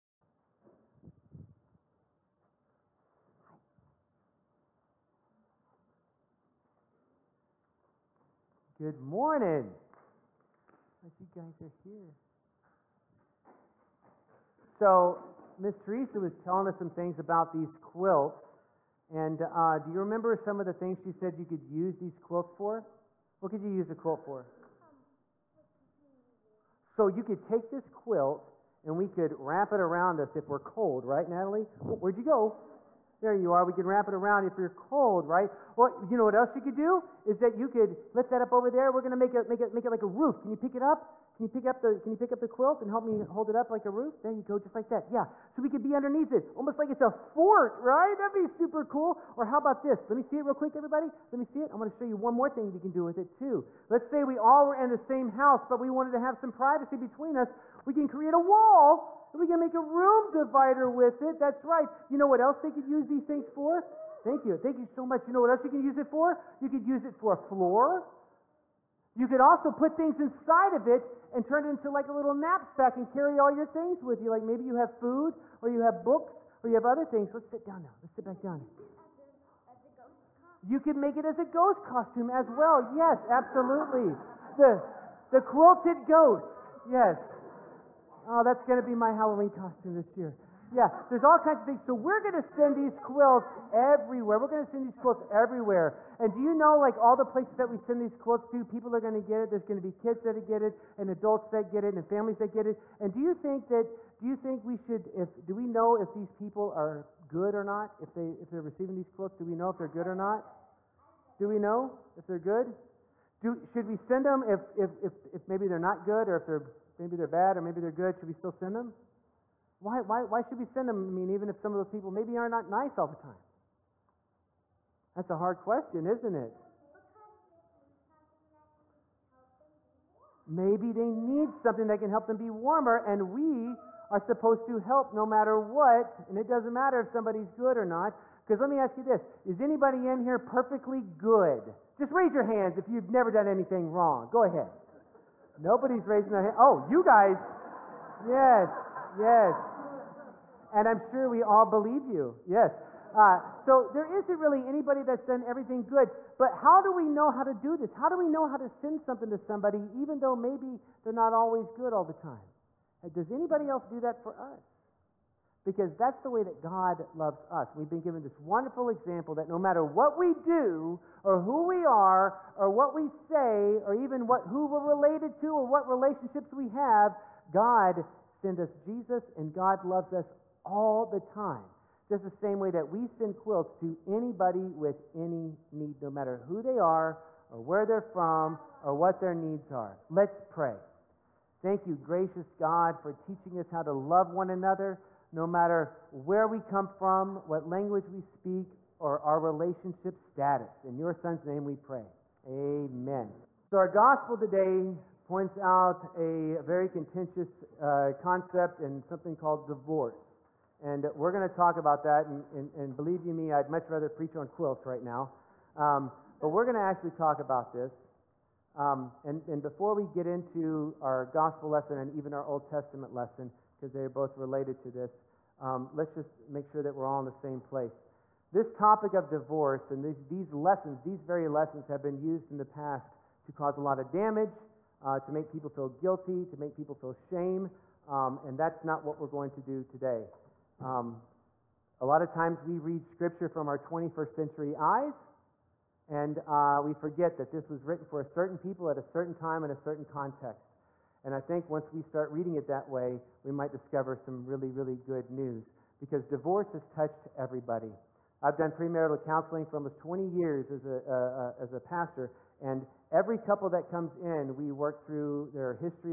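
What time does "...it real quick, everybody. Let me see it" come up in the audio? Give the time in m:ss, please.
0:50.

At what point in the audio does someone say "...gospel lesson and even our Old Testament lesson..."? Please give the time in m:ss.
3:41.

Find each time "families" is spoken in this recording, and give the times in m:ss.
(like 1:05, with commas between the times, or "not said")
1:42.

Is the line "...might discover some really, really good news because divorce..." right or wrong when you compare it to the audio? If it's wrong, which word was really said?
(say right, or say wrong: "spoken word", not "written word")
right.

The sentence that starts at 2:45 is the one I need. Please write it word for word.
because that's the way that God loves us.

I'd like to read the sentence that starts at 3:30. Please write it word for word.
And we're going to talk about that.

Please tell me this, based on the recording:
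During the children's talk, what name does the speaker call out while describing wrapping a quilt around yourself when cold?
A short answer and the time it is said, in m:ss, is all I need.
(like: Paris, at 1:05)
Natalie, at 0:31.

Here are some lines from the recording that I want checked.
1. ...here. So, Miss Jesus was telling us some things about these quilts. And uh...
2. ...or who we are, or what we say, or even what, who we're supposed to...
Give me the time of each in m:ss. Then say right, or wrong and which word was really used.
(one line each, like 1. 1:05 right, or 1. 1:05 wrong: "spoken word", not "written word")
1. 0:11 wrong: "Teresa", not "Jesus"
2. 2:51 wrong: "related", not "supposed".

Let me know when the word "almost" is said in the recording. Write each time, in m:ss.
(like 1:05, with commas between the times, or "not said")
0:46, 4:19.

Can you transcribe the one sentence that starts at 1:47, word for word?
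If, they, if they're receiving these quilts, do we know if they're good or not?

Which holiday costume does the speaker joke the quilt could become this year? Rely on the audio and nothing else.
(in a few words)
Halloween.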